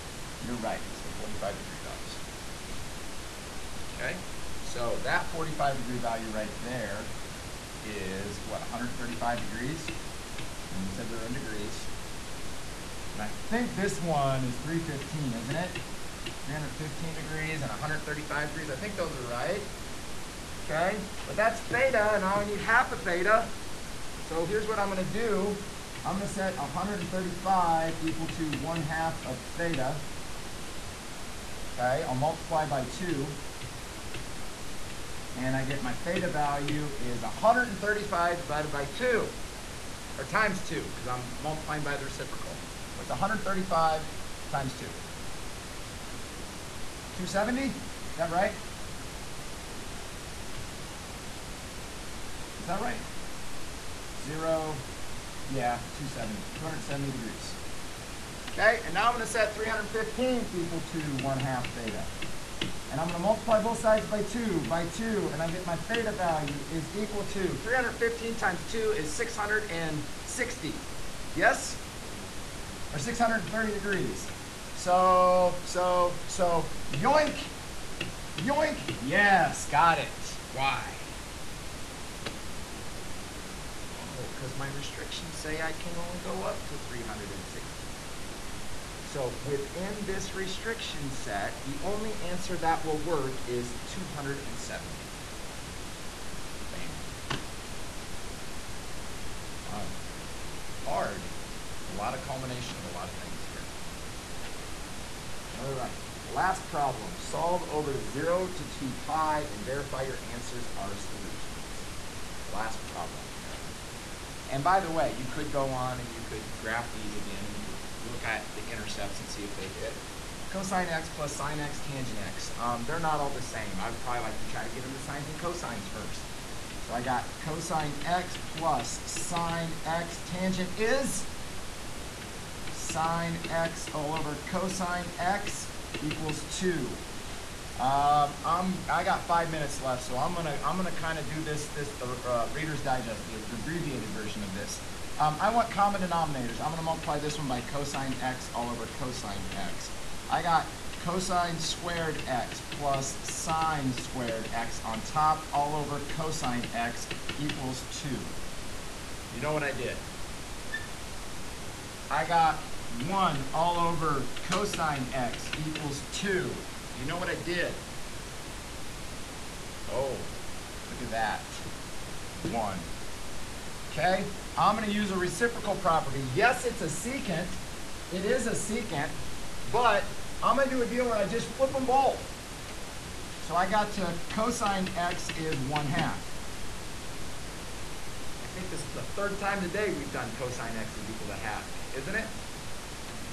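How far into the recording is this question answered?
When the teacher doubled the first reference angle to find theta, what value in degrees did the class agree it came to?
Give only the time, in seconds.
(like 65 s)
56 s.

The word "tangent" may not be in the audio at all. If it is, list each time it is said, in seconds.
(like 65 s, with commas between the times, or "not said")
121 s, 130 s.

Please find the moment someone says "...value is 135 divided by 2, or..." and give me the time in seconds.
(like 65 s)
36 s.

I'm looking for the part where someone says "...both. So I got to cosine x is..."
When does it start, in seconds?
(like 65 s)
181 s.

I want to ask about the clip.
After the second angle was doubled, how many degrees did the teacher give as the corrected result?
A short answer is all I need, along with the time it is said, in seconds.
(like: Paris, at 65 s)
630, at 72 s.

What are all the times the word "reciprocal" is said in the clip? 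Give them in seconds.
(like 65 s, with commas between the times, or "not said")
42 s, 175 s.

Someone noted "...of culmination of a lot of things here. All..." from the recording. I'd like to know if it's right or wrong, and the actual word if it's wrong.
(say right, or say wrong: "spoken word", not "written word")
right.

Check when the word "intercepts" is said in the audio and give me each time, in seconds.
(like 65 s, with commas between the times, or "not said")
118 s.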